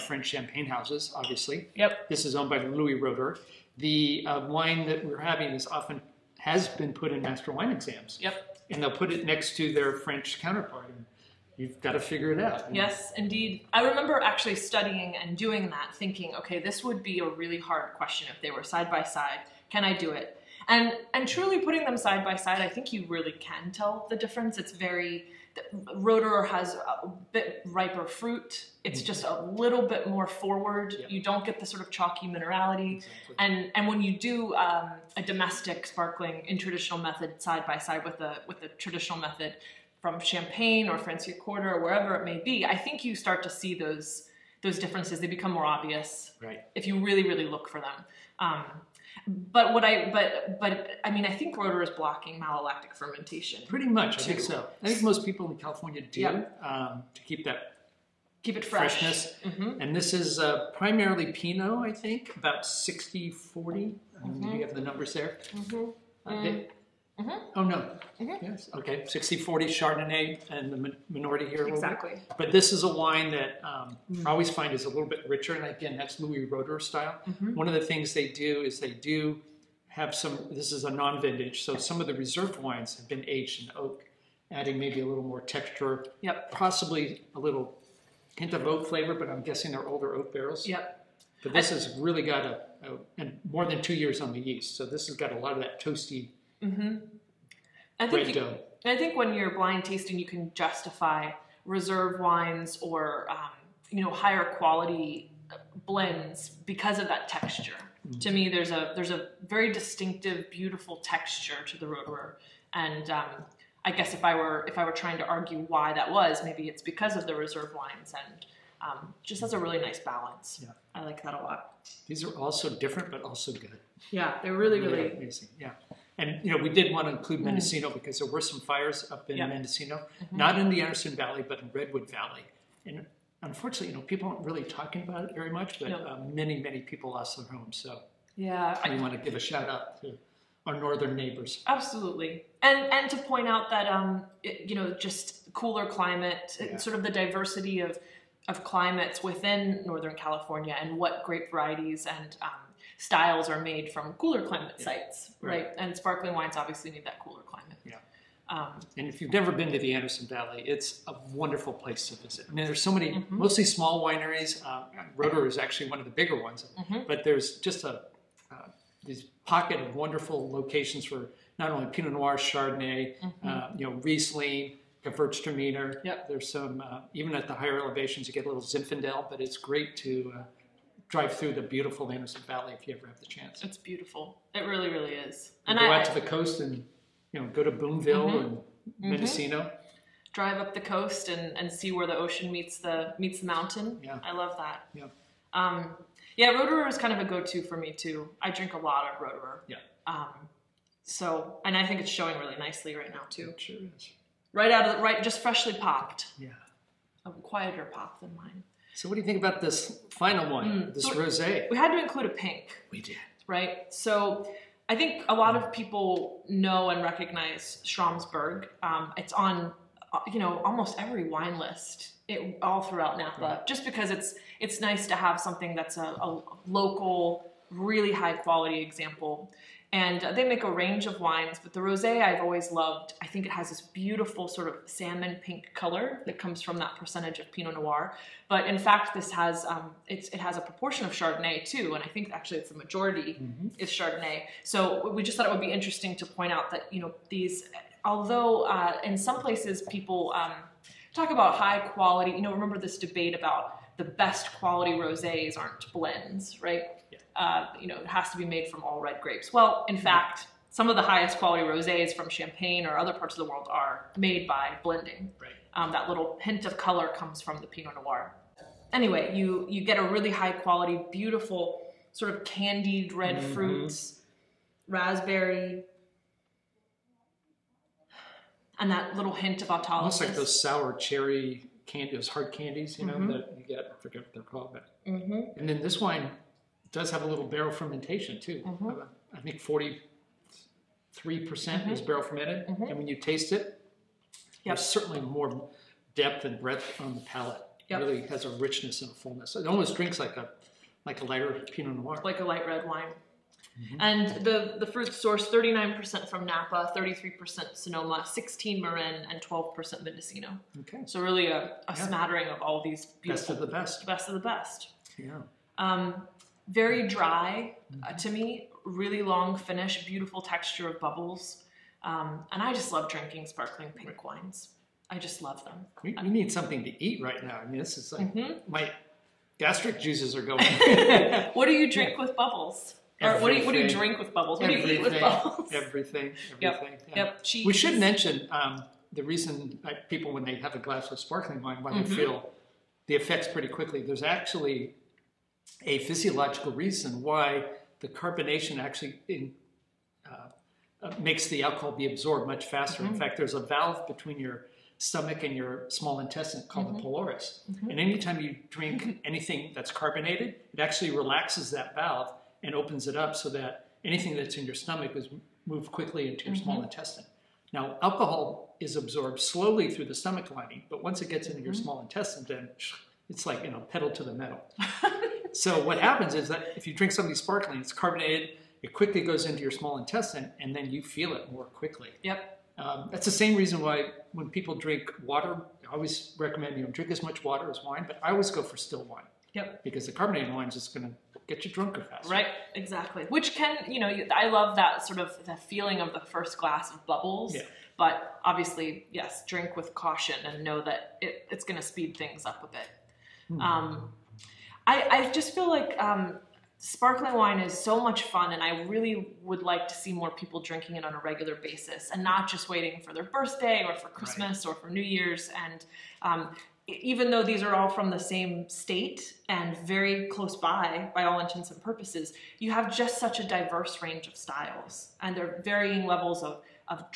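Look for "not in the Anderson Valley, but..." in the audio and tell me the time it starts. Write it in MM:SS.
02:10.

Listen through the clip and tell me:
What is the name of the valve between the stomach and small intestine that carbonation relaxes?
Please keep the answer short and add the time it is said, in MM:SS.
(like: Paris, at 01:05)
pylorus, at 05:56.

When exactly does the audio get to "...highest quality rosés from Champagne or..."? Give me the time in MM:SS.
04:21.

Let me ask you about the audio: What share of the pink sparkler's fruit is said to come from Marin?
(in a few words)
16%.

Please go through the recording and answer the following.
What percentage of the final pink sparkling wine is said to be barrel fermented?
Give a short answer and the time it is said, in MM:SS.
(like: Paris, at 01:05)
43%, at 04:49.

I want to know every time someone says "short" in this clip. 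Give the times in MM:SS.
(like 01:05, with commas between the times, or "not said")
not said.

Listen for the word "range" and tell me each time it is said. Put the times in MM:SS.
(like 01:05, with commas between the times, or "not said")
03:50, 07:04.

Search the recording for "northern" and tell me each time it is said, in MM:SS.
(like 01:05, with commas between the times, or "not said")
02:20, 02:29.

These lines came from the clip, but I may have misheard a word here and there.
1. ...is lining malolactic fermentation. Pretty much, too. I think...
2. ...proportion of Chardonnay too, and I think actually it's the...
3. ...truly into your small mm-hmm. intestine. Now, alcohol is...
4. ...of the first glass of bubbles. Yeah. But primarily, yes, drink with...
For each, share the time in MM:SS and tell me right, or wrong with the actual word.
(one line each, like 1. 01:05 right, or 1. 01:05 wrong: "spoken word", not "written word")
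1. 00:51 wrong: "blocking", not "lining"
2. 04:00 right
3. 06:05 wrong: "quickly", not "truly"
4. 06:36 wrong: "obviously", not "primarily".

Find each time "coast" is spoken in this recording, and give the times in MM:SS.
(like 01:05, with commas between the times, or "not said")
03:06, 03:10.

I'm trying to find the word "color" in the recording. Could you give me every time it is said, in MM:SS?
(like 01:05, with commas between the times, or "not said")
03:55, 04:26.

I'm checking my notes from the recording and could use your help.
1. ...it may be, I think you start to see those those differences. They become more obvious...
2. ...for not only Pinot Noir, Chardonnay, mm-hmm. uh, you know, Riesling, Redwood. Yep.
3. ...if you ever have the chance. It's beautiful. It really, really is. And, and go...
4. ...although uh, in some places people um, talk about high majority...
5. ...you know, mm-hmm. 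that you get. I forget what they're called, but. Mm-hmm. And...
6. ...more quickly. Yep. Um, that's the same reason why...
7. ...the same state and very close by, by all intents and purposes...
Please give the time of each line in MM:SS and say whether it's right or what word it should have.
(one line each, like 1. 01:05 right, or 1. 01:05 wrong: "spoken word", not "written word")
1. 00:42 right
2. 02:51 wrong: "Gewürztraminer", not "Redwood"
3. 03:02 right
4. 04:08 wrong: "quality", not "majority"
5. 04:42 right
6. 06:21 right
7. 06:58 right.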